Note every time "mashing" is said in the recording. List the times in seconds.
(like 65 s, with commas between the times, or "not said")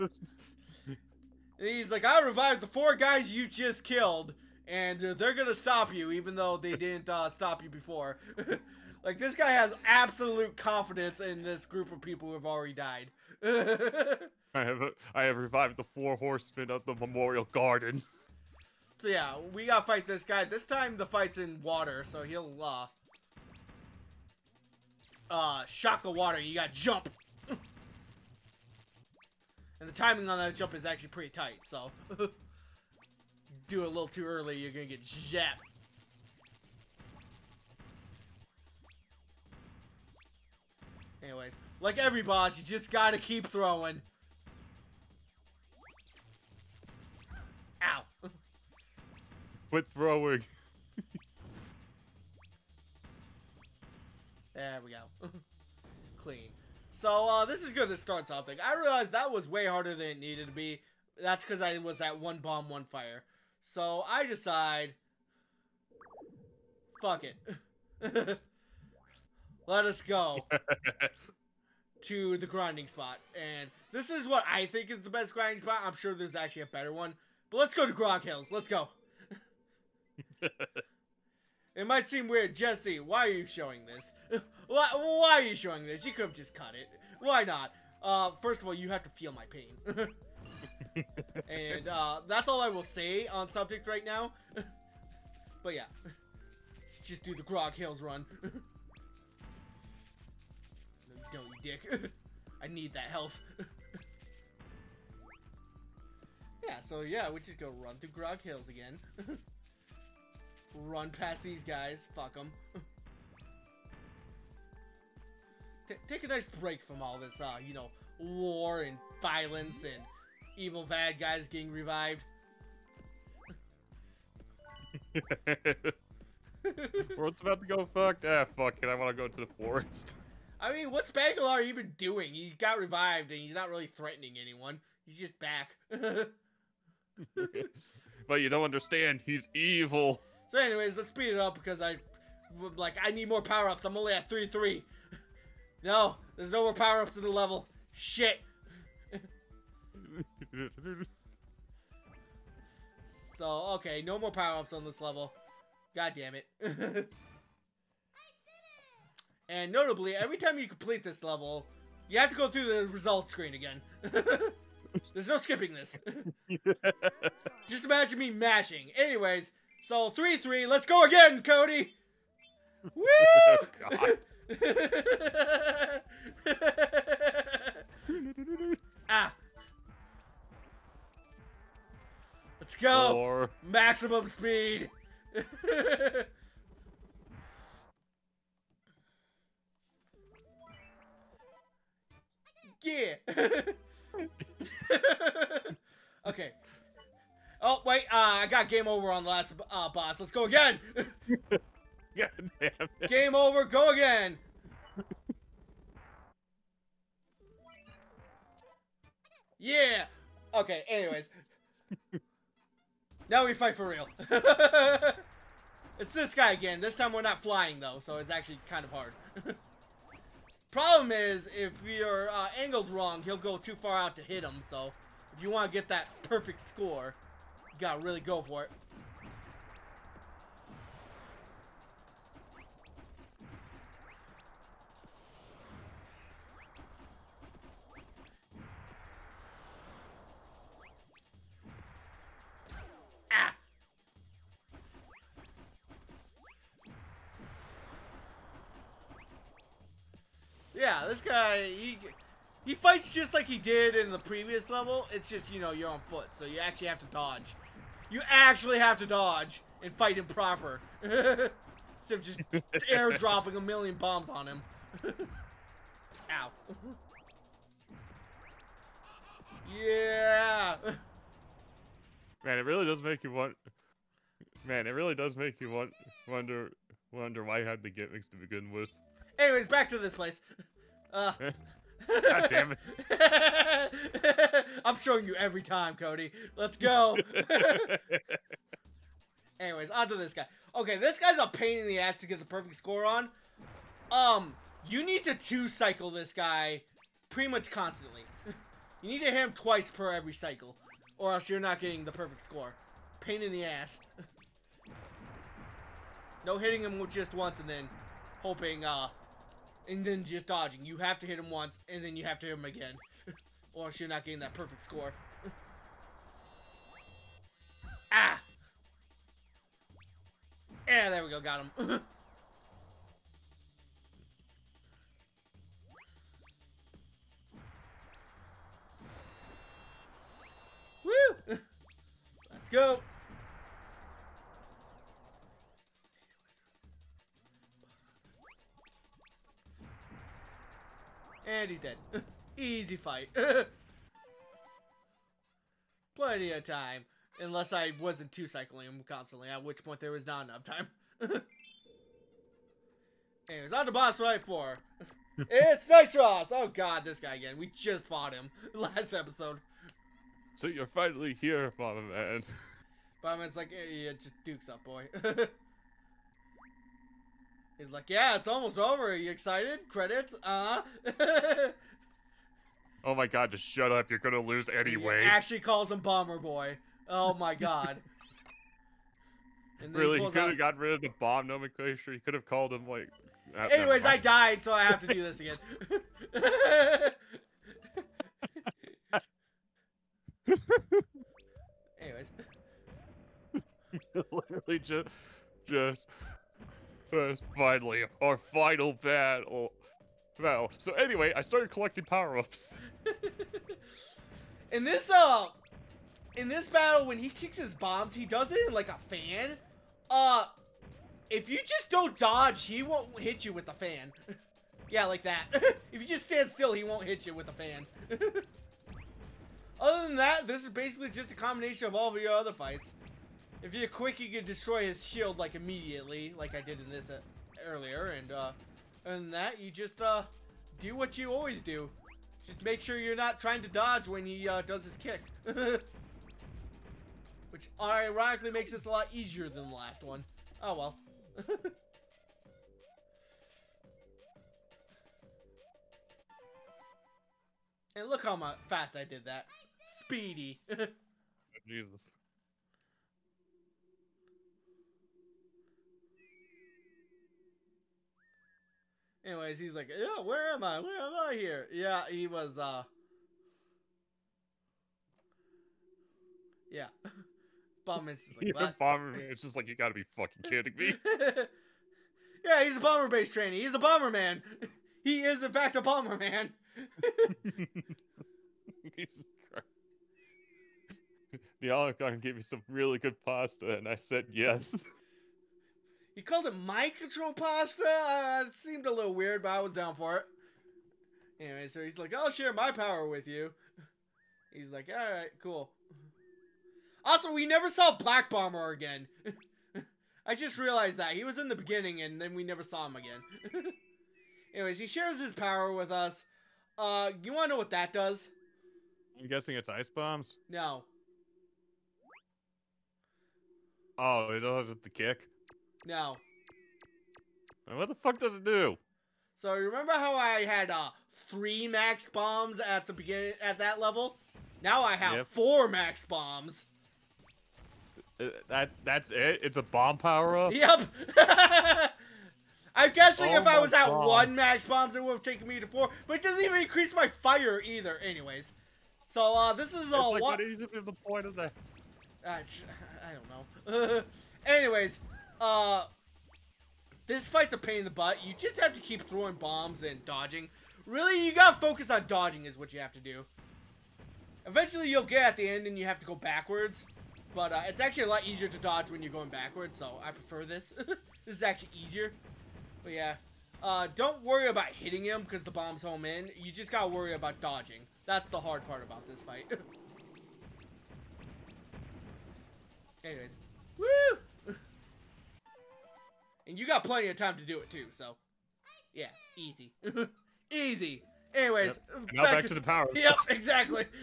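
168 s.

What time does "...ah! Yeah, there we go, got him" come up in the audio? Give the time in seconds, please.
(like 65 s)
318 s.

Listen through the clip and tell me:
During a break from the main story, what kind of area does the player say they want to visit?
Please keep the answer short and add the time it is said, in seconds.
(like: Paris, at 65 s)
the forest, at 129 s.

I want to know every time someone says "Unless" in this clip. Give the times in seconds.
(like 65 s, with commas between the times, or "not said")
347 s.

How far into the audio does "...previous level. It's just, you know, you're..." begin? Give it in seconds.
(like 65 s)
254 s.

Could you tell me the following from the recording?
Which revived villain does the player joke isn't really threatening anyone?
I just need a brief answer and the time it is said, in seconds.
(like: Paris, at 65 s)
Bagular, at 131 s.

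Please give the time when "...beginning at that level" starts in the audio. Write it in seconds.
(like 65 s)
522 s.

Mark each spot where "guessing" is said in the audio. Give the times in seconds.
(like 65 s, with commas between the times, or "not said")
509 s, 532 s.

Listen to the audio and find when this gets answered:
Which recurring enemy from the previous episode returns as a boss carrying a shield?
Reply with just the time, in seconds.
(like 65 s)
355 s.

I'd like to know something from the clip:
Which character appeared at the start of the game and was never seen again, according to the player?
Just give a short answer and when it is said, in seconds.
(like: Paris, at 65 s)
Black Bomber, at 497 s.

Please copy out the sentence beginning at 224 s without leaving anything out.
So, if you want to get that perfect score.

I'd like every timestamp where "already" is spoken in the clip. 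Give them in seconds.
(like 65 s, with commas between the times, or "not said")
12 s.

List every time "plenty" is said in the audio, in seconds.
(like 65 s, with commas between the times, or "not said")
346 s, 576 s.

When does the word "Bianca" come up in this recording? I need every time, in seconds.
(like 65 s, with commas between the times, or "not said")
481 s.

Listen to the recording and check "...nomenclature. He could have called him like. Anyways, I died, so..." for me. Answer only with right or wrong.
right.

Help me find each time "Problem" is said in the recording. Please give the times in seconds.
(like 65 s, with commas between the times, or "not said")
220 s.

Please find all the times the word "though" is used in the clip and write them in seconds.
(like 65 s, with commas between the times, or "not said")
6 s, 217 s.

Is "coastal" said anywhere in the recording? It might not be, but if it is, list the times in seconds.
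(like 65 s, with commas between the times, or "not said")
not said.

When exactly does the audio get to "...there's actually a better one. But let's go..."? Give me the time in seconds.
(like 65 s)
76 s.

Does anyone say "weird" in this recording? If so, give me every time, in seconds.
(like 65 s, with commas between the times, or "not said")
82 s, 489 s.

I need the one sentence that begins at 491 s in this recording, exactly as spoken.
Anyway, so he's like, I'll share my power with you.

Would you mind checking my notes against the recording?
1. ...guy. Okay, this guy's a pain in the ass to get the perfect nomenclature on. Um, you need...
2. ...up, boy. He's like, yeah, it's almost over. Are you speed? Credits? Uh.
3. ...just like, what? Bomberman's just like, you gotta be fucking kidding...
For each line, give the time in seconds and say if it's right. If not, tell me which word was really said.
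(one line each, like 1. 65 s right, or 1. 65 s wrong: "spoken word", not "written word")
1. 290 s wrong: "score", not "nomenclature"
2. 364 s wrong: "excited", not "speed"
3. 468 s right.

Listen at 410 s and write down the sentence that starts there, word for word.
Uh, if you just don't dodge, he won't hit you with a fan.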